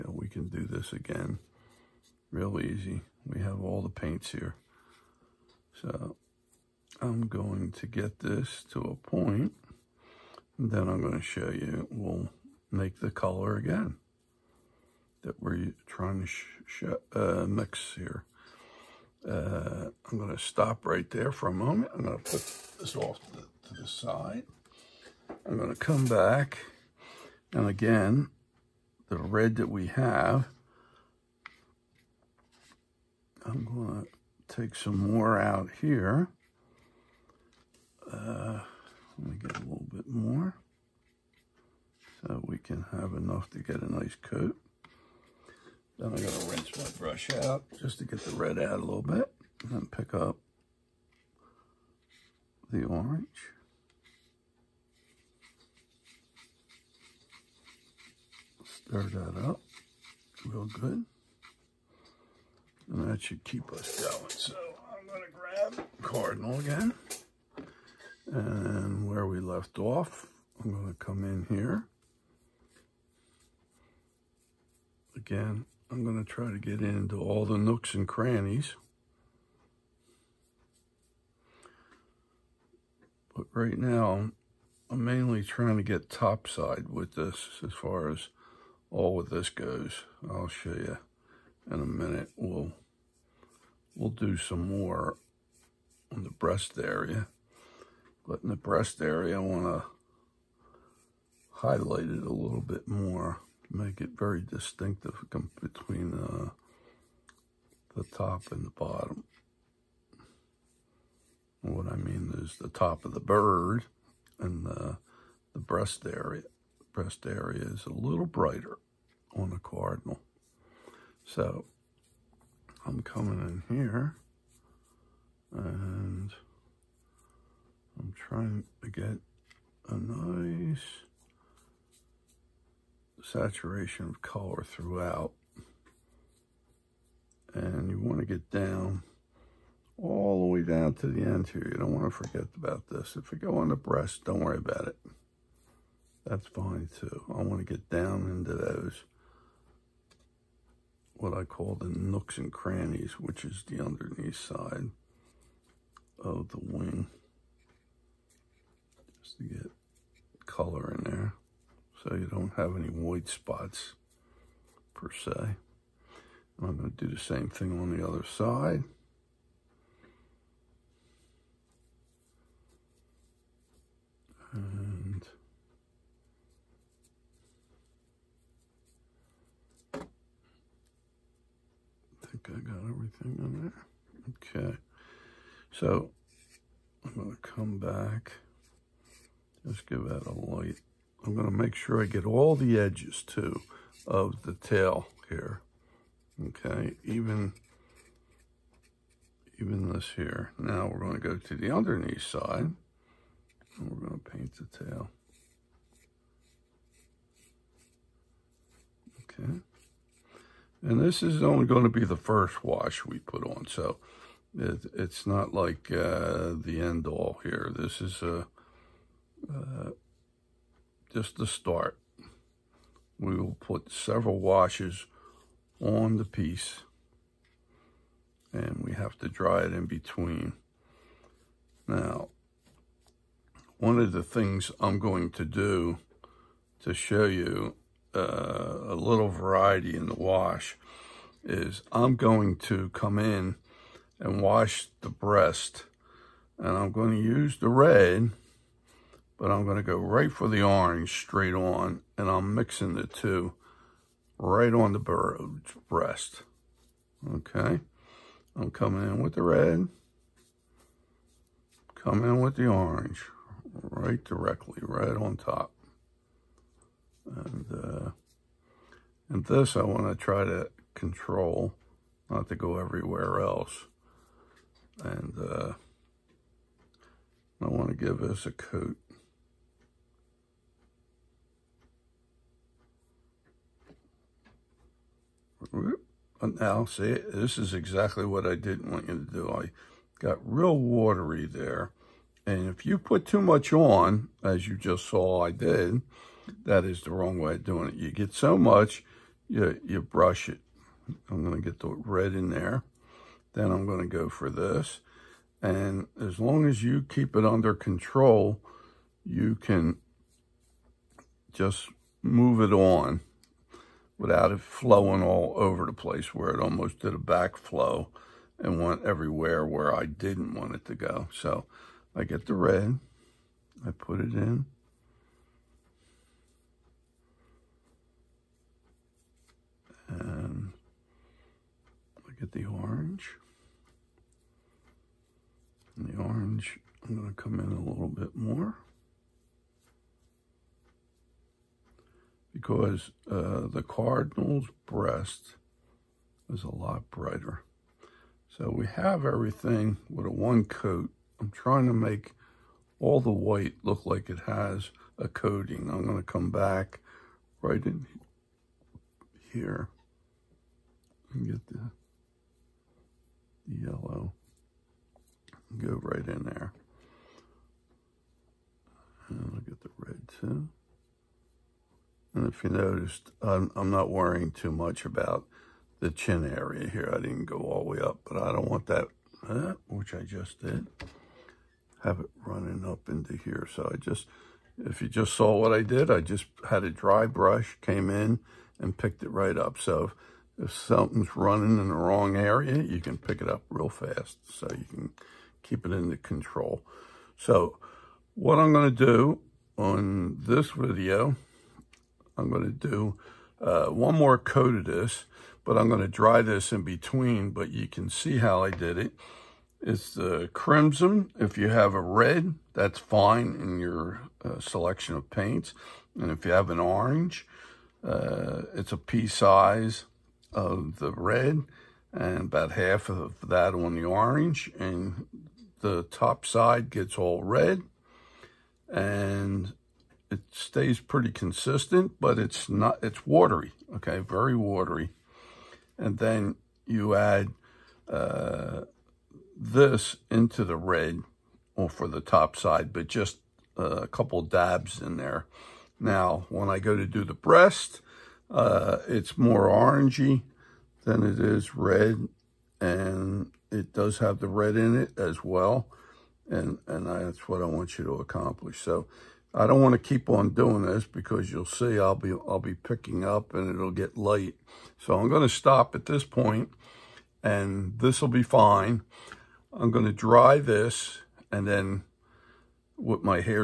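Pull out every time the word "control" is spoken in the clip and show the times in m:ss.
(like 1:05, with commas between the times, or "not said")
4:30, 5:07, 6:36.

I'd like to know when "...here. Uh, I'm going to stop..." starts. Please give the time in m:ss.
0:17.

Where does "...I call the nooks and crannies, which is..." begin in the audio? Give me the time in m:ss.
2:31.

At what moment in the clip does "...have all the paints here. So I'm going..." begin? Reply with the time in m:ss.
0:03.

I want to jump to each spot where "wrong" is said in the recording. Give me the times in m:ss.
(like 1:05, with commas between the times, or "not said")
4:57, 6:31.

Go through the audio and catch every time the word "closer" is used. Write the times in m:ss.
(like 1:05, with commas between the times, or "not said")
not said.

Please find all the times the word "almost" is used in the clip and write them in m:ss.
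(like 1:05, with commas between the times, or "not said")
5:16.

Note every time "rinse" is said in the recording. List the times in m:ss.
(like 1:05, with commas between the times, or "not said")
0:46.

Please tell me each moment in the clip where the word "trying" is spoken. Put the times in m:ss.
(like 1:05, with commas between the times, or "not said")
0:15, 1:25, 2:08, 5:51.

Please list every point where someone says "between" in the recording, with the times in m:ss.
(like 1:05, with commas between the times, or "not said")
1:45, 3:49, 6:46.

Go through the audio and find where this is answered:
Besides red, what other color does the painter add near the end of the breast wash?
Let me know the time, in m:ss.
6:03.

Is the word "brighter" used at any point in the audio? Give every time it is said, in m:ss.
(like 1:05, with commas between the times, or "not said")
1:58, 5:47.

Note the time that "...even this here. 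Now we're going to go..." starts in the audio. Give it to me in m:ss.
3:19.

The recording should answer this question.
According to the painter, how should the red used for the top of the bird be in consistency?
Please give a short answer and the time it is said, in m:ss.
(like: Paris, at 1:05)
very watery, at 7:14.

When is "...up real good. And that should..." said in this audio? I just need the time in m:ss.
0:59.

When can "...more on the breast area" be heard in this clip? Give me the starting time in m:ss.
1:34.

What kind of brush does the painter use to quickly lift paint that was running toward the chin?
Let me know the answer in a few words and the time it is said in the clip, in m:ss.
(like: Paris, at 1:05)
dry brush, at 6:26.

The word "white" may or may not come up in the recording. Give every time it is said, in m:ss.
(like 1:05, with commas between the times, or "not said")
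2:42, 5:53.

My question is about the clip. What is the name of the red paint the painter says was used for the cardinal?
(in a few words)
crimson.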